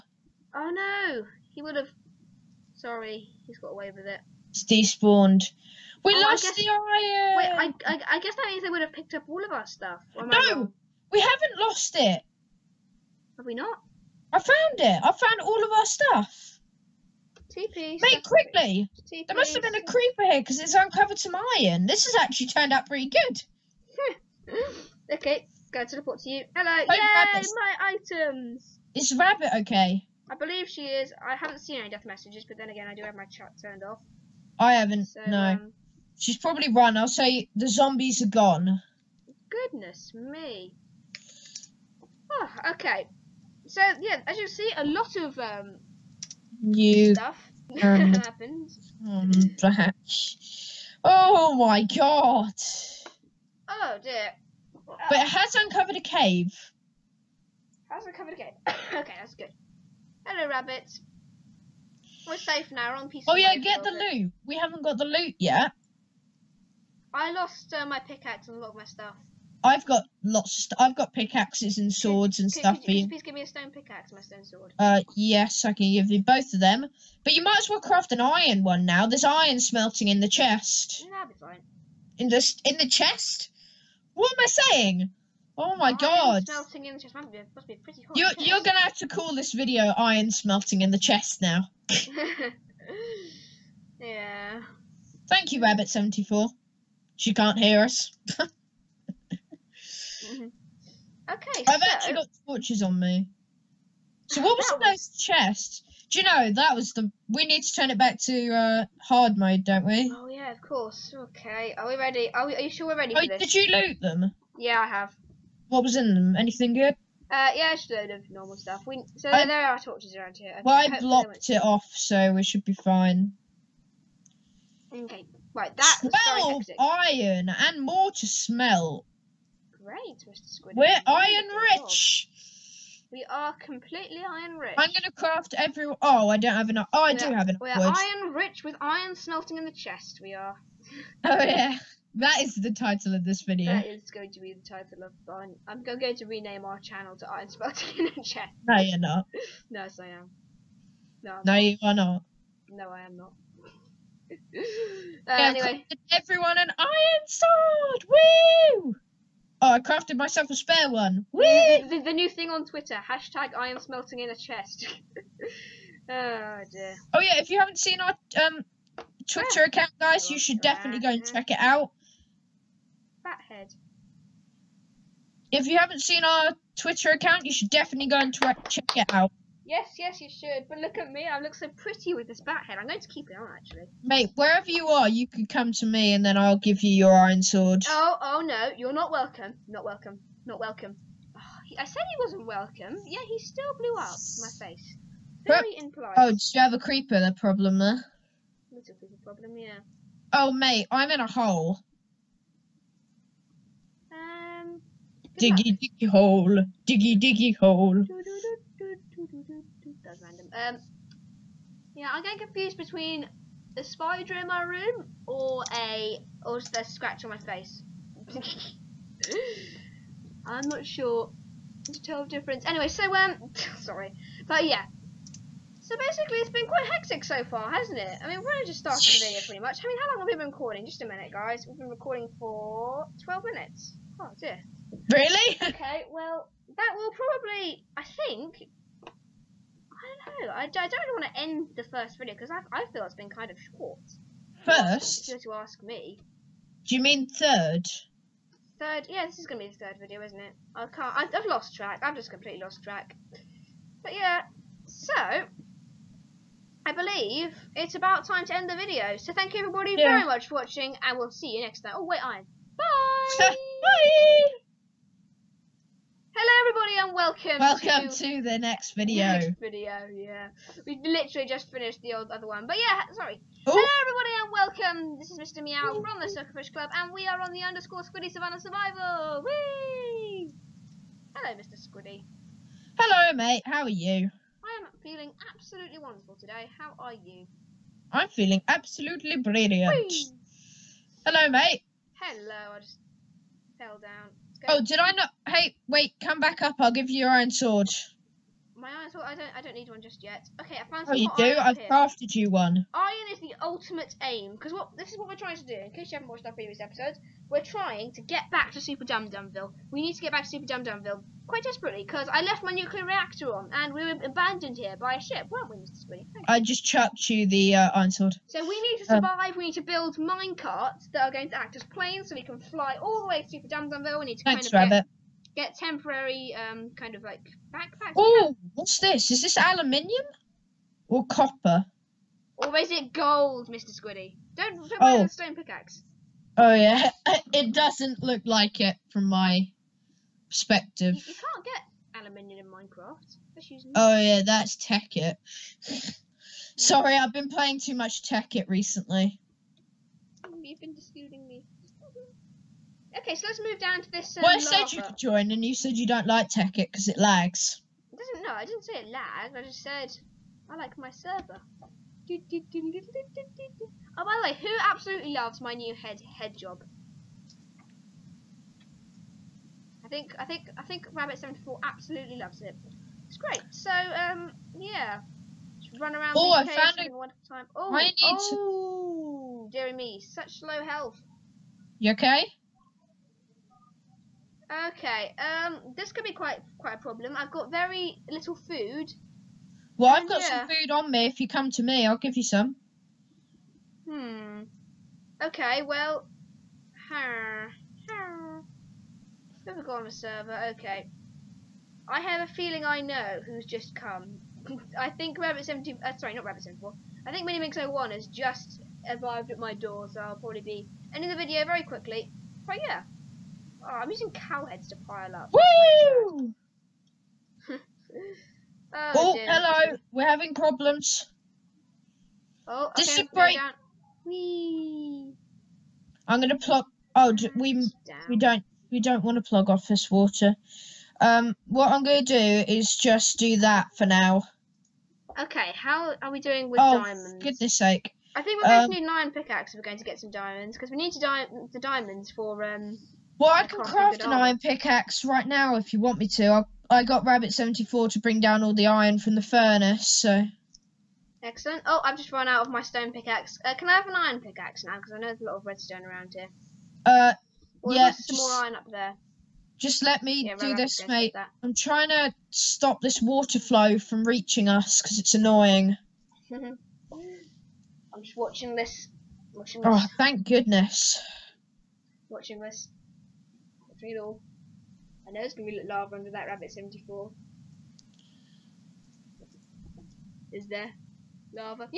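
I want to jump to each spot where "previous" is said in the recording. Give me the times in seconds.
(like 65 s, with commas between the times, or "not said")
306 s.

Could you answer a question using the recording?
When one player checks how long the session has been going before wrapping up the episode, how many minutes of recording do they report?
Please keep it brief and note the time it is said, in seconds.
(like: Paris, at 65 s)
12, at 233 s.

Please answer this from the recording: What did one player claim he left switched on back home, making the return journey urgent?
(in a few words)
nuclear reactor.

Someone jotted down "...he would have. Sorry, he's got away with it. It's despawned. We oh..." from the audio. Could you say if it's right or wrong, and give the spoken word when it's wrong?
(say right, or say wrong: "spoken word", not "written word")
right.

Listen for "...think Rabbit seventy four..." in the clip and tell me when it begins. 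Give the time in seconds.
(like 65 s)
370 s.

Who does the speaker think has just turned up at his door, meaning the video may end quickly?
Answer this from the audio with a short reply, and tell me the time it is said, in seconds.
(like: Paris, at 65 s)
Minimix01, at 407 s.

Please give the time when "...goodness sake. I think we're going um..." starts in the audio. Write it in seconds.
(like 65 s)
437 s.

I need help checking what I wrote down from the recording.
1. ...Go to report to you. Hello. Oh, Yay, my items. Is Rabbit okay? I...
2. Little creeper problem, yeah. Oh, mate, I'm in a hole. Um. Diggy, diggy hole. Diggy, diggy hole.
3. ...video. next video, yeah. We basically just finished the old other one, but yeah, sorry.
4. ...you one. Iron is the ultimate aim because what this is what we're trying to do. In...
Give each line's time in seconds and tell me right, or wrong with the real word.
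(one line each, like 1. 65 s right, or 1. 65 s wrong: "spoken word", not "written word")
1. 25 s right
2. 198 s right
3. 268 s wrong: "literally", not "basically"
4. 302 s right.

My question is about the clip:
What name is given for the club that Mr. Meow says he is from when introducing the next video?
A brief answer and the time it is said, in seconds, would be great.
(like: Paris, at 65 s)
Suckerfish Club, at 276 s.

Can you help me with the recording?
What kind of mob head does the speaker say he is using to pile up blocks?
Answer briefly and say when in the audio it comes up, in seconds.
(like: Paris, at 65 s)
cow heads, at 414 s.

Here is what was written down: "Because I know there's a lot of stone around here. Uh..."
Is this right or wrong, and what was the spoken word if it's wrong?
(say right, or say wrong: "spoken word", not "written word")
wrong: "redstone", not "stone".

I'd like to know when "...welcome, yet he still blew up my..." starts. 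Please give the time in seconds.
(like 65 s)
192 s.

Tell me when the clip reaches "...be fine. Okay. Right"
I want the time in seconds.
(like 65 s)
122 s.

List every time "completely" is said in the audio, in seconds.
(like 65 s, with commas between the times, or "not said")
133 s, 252 s.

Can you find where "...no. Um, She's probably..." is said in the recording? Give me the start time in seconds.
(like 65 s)
35 s.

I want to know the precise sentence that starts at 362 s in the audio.
Oh, by the way, who absolutely loves my new head head job?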